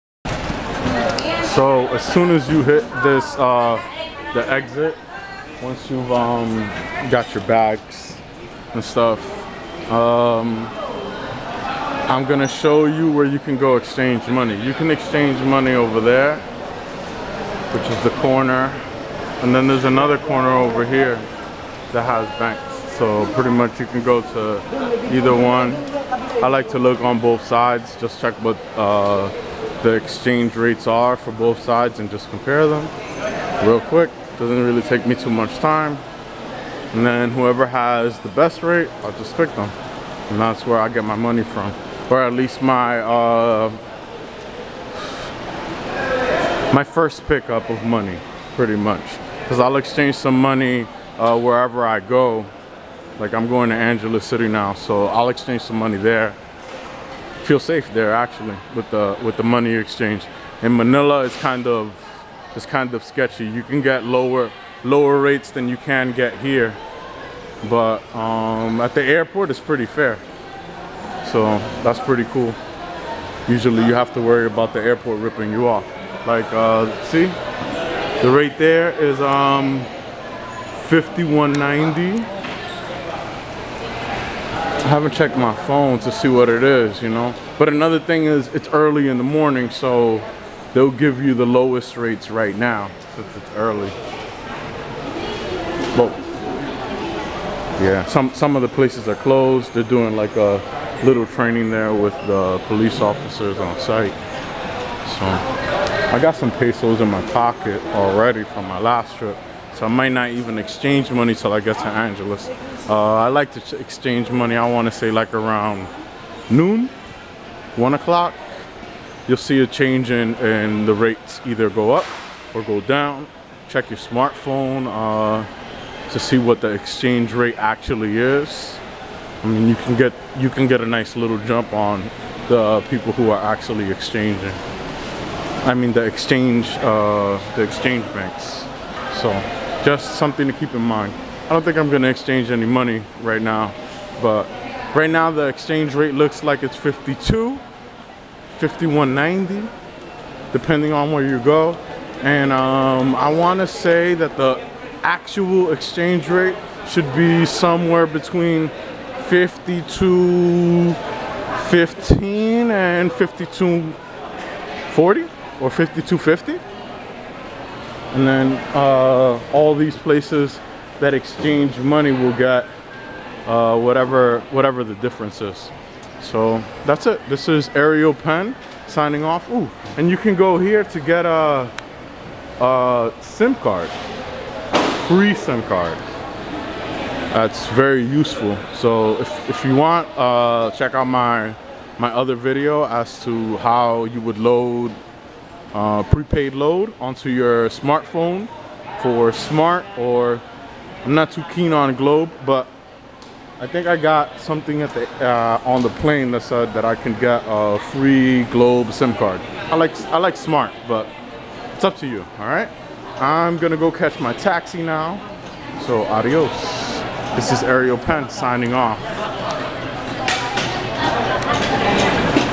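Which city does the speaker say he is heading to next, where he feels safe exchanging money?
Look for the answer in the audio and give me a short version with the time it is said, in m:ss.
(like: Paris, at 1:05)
Angeles City, at 0:53.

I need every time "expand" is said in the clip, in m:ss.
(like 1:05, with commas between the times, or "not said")
not said.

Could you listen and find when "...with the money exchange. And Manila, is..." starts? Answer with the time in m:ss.
0:59.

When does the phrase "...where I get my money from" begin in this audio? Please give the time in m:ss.
0:40.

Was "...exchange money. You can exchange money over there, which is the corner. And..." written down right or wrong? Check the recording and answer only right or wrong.
right.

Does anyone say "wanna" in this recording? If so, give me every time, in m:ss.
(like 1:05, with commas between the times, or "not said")
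2:33.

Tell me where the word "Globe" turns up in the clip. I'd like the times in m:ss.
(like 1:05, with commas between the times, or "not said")
3:21, 3:28.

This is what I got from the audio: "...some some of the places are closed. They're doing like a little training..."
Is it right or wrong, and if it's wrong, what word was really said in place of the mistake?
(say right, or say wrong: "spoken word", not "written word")
right.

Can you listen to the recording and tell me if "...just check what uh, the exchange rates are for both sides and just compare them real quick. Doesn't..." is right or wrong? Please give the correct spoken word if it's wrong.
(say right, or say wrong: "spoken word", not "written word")
right.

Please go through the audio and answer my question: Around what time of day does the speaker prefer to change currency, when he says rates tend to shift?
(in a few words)
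1 o'clock.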